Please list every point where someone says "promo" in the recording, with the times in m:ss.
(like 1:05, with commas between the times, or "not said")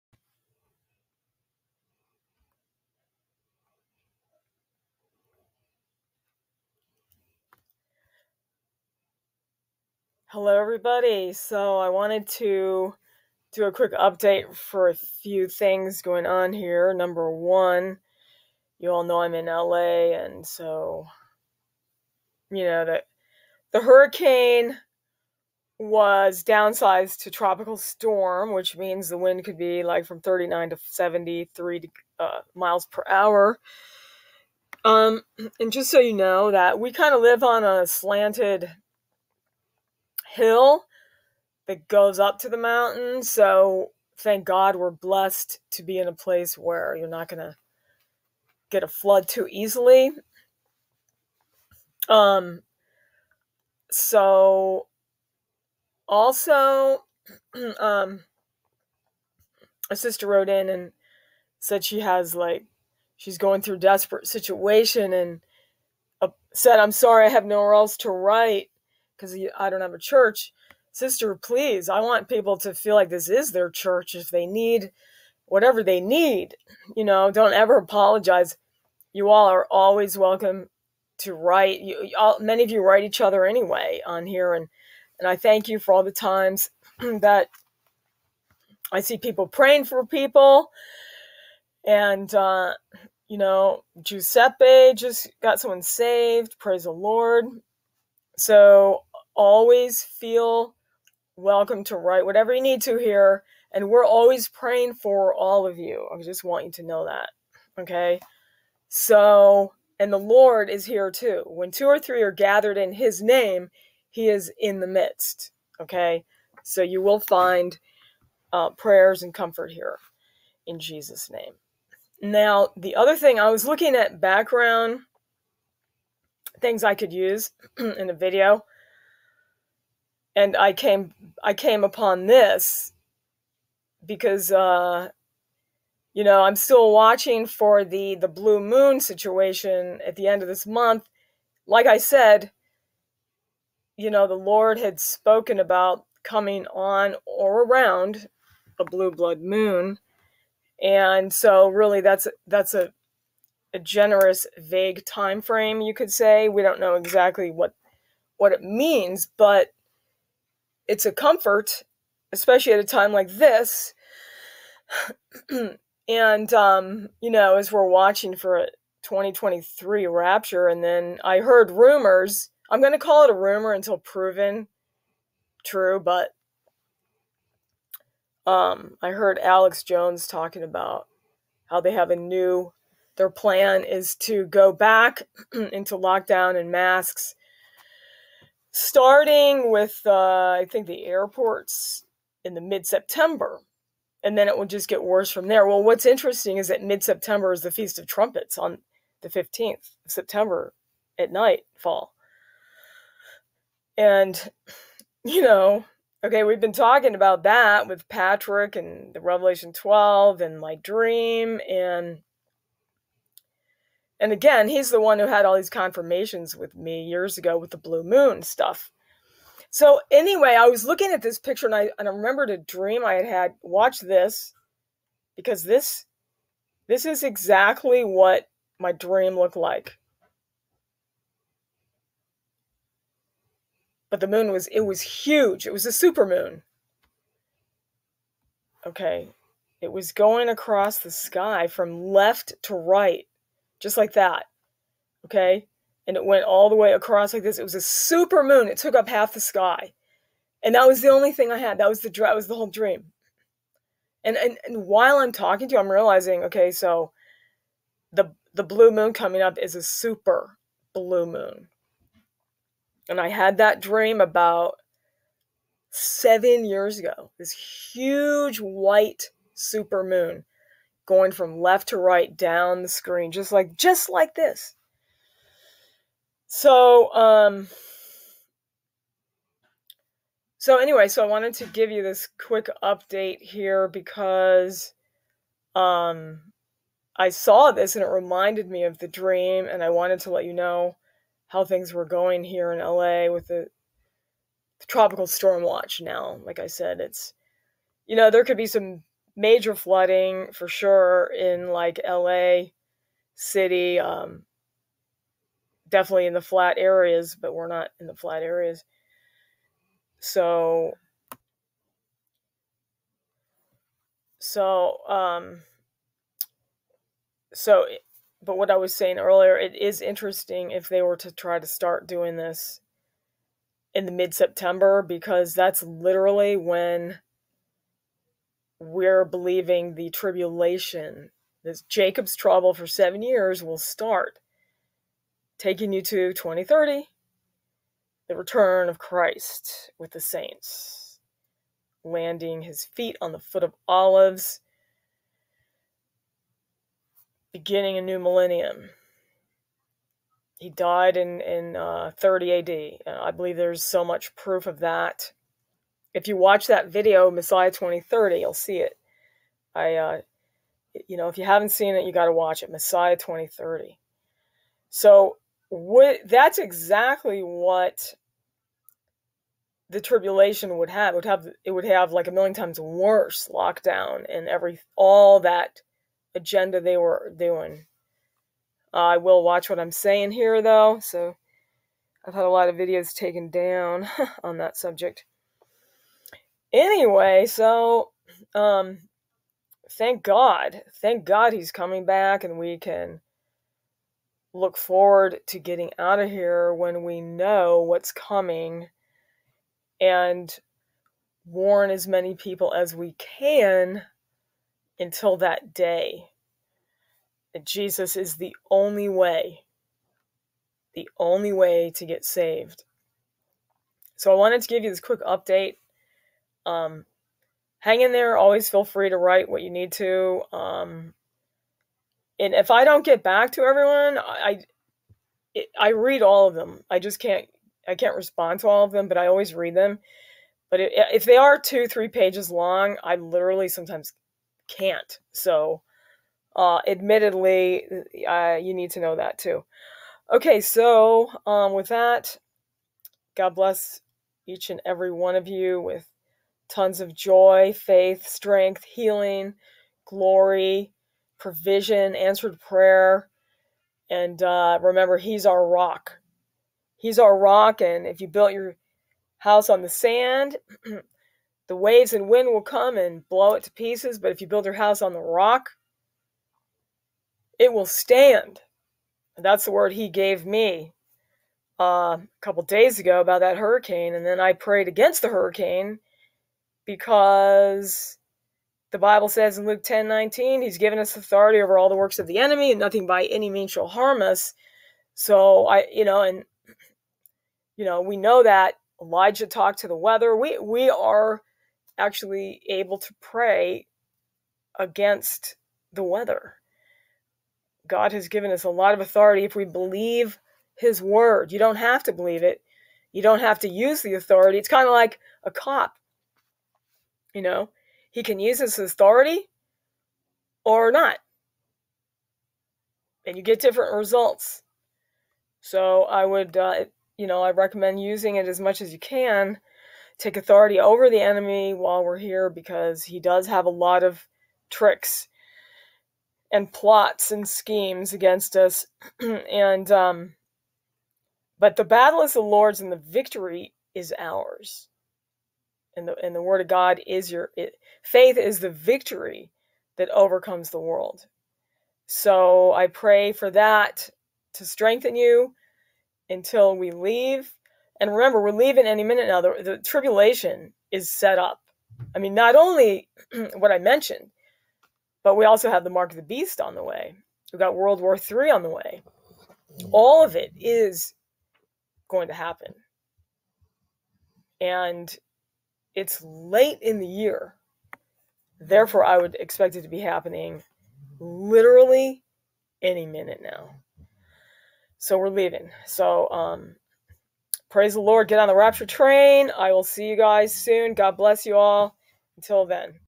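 not said.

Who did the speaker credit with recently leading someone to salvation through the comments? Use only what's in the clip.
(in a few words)
Giuseppe.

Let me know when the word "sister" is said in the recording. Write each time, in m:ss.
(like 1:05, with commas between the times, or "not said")
0:59, 1:10.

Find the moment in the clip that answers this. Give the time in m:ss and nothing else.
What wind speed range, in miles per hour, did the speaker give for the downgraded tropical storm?
0:30.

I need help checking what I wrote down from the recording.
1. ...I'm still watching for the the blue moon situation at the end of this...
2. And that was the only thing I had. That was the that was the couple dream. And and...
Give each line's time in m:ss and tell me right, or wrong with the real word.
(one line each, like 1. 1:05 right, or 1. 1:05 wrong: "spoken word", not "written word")
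1. 2:16 right
2. 4:10 wrong: "whole", not "couple".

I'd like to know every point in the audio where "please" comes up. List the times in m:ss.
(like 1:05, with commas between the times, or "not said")
1:11.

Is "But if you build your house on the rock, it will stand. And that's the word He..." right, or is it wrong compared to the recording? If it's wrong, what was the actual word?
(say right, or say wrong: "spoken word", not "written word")
right.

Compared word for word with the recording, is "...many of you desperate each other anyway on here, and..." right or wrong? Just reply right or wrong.
wrong.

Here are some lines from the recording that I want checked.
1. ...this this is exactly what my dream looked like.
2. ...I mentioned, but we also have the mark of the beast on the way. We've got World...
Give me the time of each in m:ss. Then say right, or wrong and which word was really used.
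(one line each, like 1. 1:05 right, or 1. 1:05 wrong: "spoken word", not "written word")
1. 3:45 right
2. 9:13 right.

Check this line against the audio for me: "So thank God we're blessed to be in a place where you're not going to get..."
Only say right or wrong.
right.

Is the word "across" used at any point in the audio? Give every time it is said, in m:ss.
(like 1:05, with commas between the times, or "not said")
4:00, 4:06.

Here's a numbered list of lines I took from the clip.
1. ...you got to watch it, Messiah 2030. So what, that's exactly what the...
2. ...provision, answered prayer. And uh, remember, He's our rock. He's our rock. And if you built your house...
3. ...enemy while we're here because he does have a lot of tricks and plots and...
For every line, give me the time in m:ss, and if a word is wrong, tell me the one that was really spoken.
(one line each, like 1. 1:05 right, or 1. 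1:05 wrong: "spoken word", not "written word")
1. 6:02 right
2. 7:31 right
3. 8:41 right.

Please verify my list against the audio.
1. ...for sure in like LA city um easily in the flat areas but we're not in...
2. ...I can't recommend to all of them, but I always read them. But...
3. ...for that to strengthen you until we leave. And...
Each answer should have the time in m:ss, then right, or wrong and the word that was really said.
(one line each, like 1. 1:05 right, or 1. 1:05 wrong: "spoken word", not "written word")
1. 5:00 wrong: "definitely", not "easily"
2. 7:07 wrong: "respond", not "recommend"
3. 9:03 right.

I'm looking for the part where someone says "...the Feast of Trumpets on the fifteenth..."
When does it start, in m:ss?
3:17.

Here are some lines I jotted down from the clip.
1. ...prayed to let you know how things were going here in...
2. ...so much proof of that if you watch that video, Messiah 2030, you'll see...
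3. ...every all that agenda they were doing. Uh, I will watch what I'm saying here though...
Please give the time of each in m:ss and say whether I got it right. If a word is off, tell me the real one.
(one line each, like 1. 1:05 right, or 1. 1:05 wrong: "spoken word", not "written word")
1. 4:49 wrong: "wanted", not "prayed"
2. 5:53 right
3. 6:14 right.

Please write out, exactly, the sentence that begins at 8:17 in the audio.
God has given us a lot of authority if we believe his word.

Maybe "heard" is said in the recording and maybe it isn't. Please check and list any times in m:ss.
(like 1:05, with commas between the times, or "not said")
2:51, 2:59.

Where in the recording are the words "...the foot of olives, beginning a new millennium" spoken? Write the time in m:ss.
5:43.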